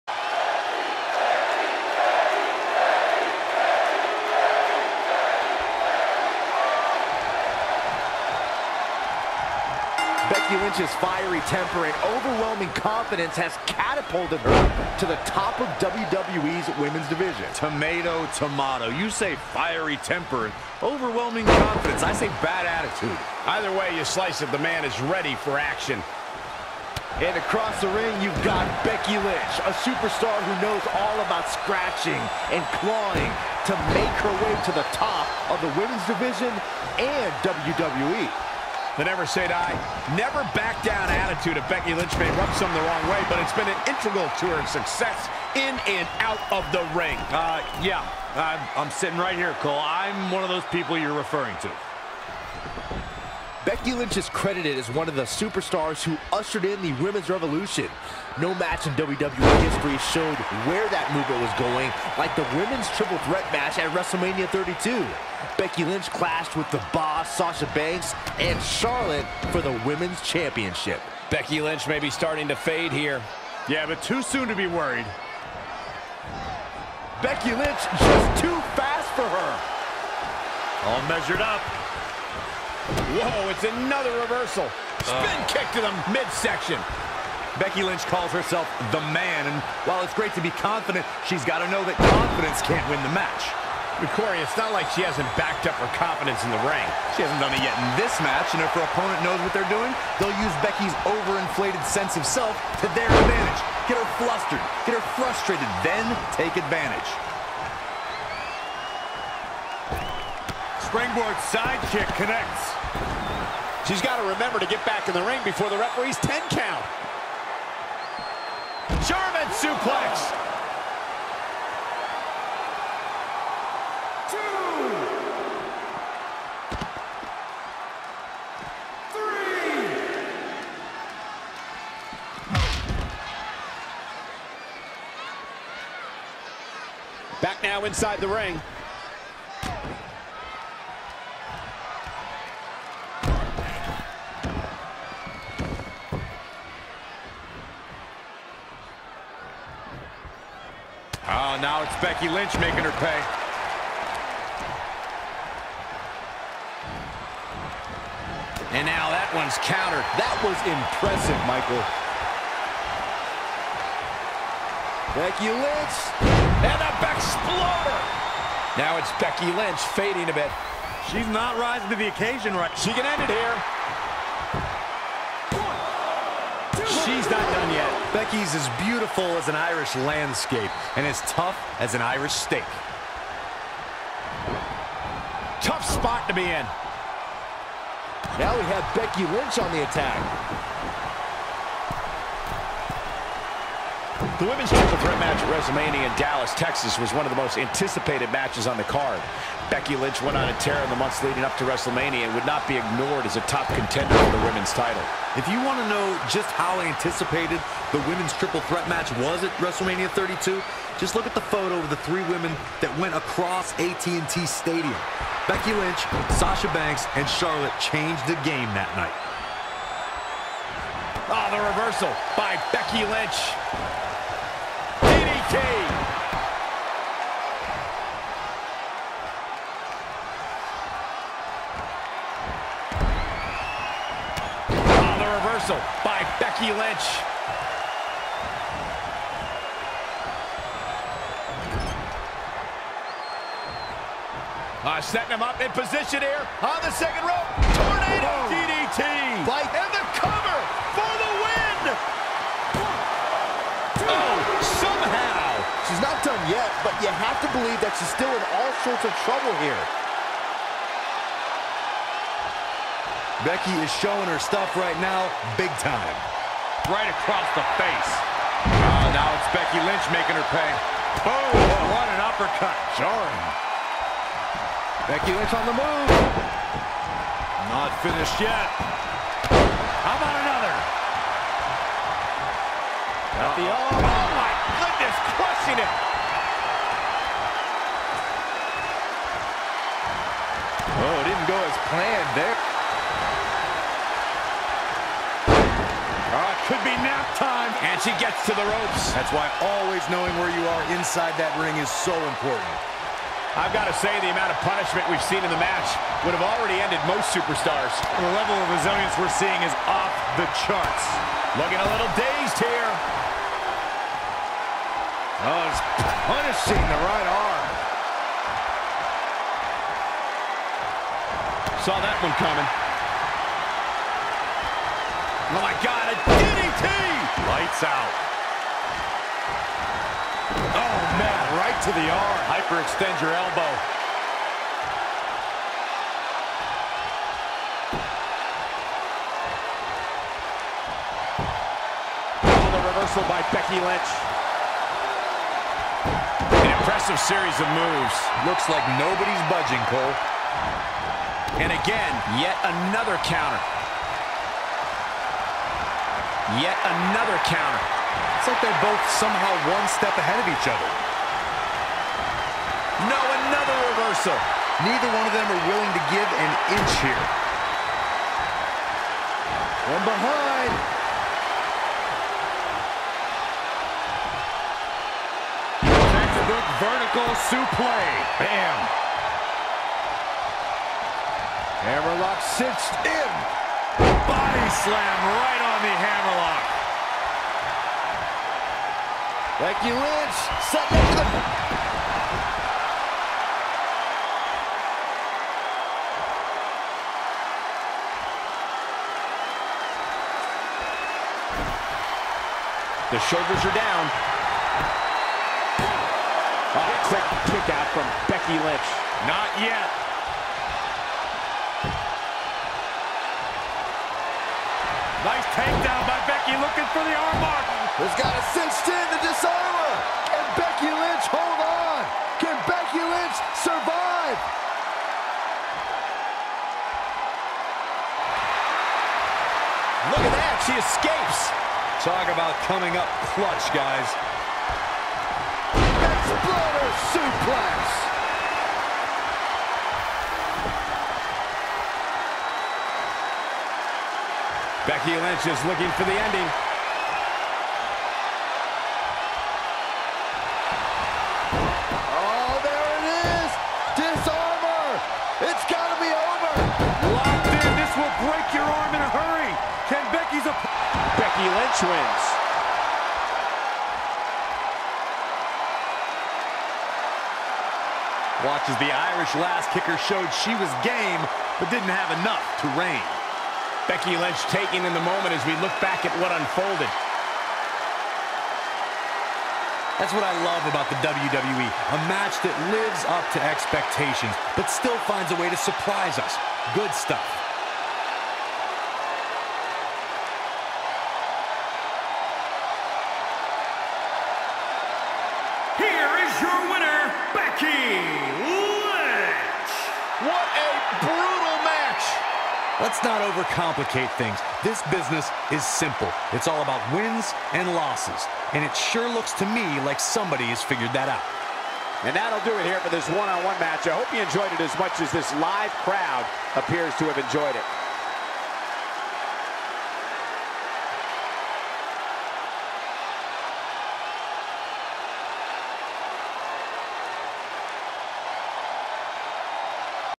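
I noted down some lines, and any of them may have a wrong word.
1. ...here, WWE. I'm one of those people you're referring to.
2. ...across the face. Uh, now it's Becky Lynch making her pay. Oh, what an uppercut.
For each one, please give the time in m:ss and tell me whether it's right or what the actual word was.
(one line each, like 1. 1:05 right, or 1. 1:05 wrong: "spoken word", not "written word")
1. 0:49 wrong: "Cole", not "WWE"
2. 4:27 right.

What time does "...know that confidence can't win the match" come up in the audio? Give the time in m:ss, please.
1:31.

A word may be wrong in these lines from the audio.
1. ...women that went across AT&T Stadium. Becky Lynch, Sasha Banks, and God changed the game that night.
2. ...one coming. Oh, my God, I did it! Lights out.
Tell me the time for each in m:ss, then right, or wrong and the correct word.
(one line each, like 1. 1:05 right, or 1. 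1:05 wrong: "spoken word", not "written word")
1. 3:32 wrong: "Charlotte", not "God"
2. 5:22 right.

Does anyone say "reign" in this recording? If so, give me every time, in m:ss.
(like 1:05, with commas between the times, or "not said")
7:52.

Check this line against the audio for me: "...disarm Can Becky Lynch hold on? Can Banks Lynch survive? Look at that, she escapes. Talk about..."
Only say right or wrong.
wrong.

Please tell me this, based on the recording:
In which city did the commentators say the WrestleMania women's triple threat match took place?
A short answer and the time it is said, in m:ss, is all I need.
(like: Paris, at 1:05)
Dallas, Texas, at 3:16.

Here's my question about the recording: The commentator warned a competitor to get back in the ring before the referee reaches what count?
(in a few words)
10.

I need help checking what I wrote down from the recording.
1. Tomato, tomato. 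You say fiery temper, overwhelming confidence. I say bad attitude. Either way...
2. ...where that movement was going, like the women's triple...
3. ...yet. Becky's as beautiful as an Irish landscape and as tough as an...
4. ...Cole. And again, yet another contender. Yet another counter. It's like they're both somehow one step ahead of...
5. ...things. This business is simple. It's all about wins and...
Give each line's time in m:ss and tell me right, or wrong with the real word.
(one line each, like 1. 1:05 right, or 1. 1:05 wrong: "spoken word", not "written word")
1. 0:17 right
2. 1:00 right
3. 2:57 right
4. 5:49 wrong: "counter", not "contender"
5. 8:24 right.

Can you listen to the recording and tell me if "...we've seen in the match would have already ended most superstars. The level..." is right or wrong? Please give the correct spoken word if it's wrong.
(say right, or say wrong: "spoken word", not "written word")
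right.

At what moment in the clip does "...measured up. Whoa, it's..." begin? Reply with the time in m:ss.
1:21.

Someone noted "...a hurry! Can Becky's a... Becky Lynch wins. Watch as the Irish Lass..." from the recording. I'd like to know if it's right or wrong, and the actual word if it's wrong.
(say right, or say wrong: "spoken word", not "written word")
right.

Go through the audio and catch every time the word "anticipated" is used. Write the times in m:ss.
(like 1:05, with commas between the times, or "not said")
3:17, 3:26.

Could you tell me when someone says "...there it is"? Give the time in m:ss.
7:32.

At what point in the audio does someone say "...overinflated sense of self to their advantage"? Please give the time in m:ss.
1:41.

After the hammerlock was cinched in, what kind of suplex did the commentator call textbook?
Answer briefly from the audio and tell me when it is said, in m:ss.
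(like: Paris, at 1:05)
vertical suplex, at 6:16.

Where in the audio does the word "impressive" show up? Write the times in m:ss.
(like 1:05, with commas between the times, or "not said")
2:40, 5:46.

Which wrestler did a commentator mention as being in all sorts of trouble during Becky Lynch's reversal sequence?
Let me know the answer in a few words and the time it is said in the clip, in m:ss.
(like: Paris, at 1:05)
Hendricks, at 4:17.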